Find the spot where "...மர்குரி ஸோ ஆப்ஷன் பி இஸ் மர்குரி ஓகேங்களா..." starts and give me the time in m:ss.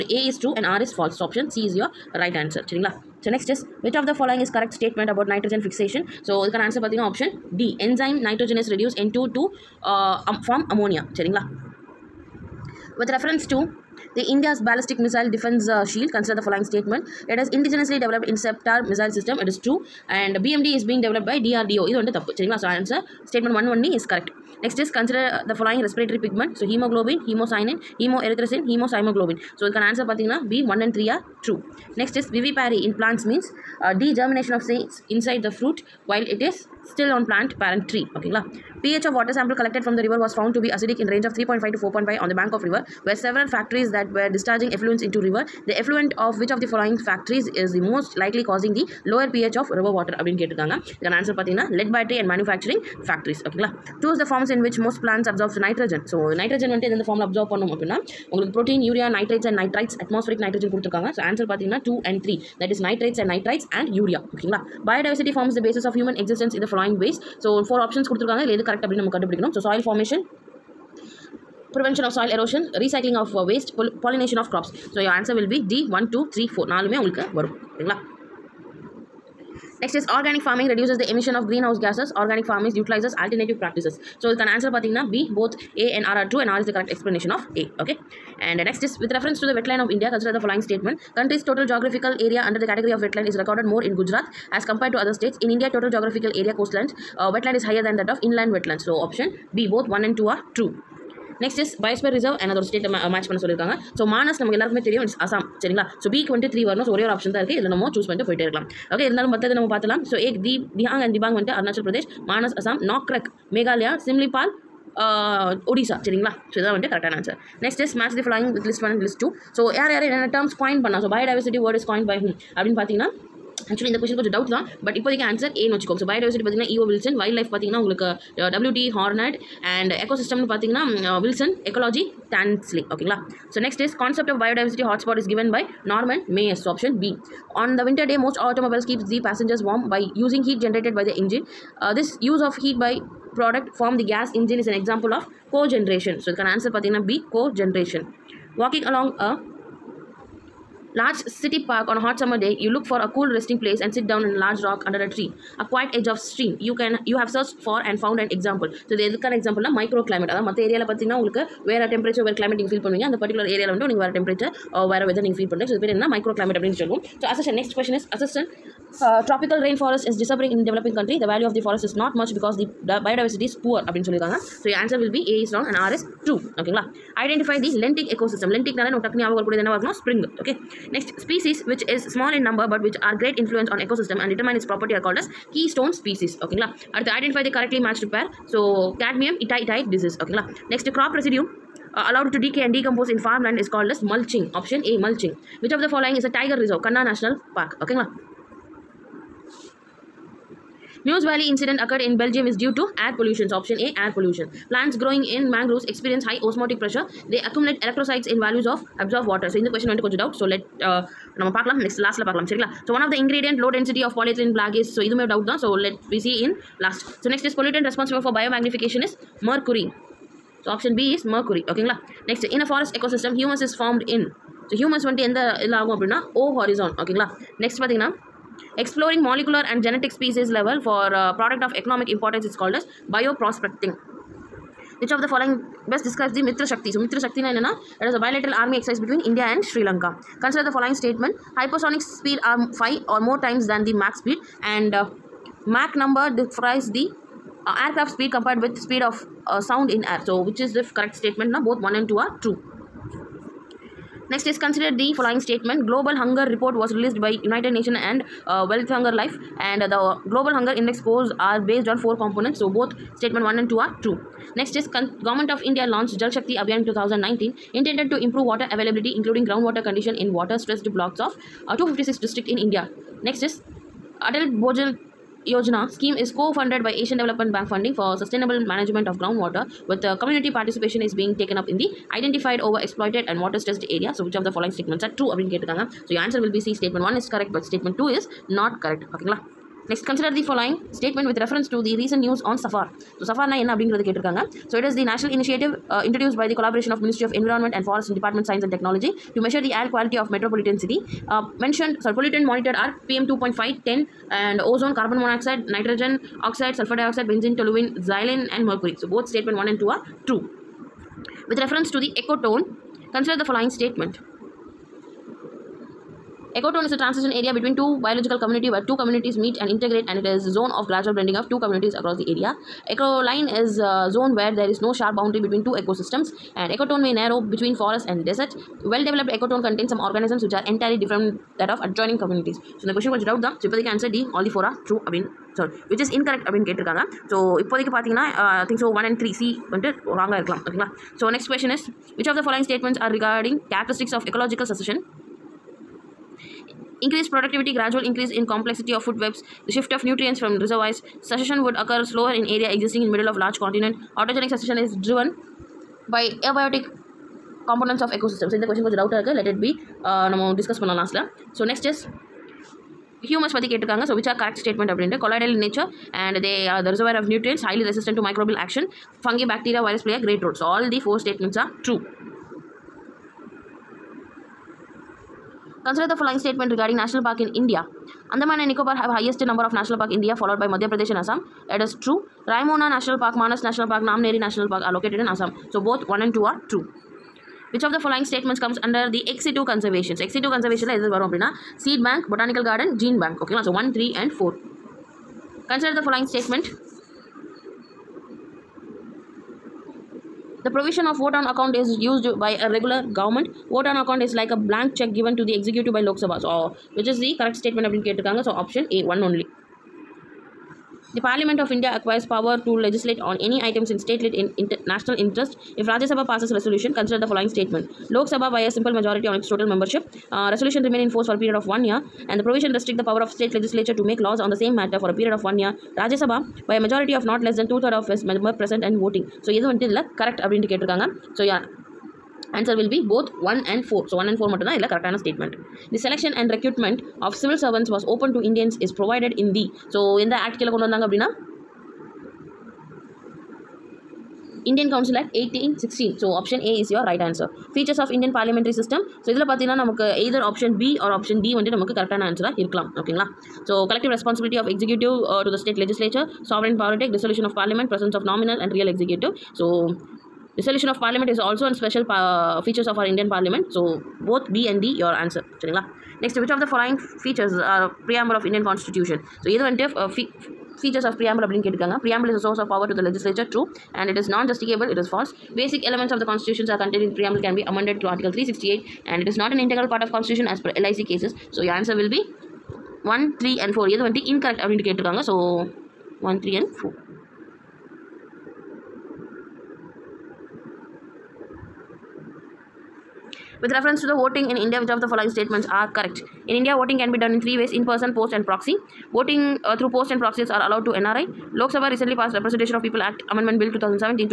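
3:39.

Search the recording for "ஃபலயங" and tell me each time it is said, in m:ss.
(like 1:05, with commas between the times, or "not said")
0:25, 1:06, 5:42, 6:36.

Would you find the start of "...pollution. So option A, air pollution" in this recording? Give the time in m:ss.
3:23.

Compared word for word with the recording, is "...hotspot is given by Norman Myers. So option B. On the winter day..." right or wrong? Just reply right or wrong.
right.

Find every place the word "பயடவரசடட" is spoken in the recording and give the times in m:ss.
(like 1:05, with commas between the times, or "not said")
1:04, 2:01, 2:06.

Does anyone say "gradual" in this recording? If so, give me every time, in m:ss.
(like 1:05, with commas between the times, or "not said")
5:20, 5:47.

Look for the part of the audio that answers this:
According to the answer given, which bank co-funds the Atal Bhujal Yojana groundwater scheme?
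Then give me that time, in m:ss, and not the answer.
4:36.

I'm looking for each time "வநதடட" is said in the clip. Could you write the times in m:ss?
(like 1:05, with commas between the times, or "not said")
0:56, 1:46, 1:51, 1:56, 3:45, 5:39, 7:09.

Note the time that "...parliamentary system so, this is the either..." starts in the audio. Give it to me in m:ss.
7:28.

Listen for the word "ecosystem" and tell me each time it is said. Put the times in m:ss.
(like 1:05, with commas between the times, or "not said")
2:58, 3:03, 5:25, 5:58.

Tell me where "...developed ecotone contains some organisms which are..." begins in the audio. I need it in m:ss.
5:29.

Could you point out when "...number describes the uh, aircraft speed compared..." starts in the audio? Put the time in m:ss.
4:06.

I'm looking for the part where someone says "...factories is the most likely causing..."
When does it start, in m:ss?
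0:47.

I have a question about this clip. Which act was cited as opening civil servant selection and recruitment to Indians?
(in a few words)
Indian Council Act 1816.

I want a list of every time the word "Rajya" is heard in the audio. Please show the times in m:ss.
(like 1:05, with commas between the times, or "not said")
6:55, 7:05.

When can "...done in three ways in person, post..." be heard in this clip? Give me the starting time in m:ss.
8:17.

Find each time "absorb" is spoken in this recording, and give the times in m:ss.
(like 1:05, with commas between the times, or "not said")
0:55, 3:29.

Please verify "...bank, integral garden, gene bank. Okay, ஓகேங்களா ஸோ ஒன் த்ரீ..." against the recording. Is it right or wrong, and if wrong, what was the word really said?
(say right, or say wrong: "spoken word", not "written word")
wrong: "botanical", not "integral".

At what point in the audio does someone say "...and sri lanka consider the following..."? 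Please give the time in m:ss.
3:59.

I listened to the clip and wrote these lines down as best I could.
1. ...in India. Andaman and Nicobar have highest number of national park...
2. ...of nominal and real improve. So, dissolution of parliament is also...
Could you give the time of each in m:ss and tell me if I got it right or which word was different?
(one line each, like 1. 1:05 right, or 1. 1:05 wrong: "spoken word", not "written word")
1. 6:17 right
2. 7:38 wrong: "executive", not "improve".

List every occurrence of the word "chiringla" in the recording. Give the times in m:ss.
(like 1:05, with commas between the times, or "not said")
0:02, 0:11.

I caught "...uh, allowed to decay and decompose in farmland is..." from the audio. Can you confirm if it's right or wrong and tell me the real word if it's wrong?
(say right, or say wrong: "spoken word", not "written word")
right.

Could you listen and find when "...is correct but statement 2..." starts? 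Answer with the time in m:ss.
4:47.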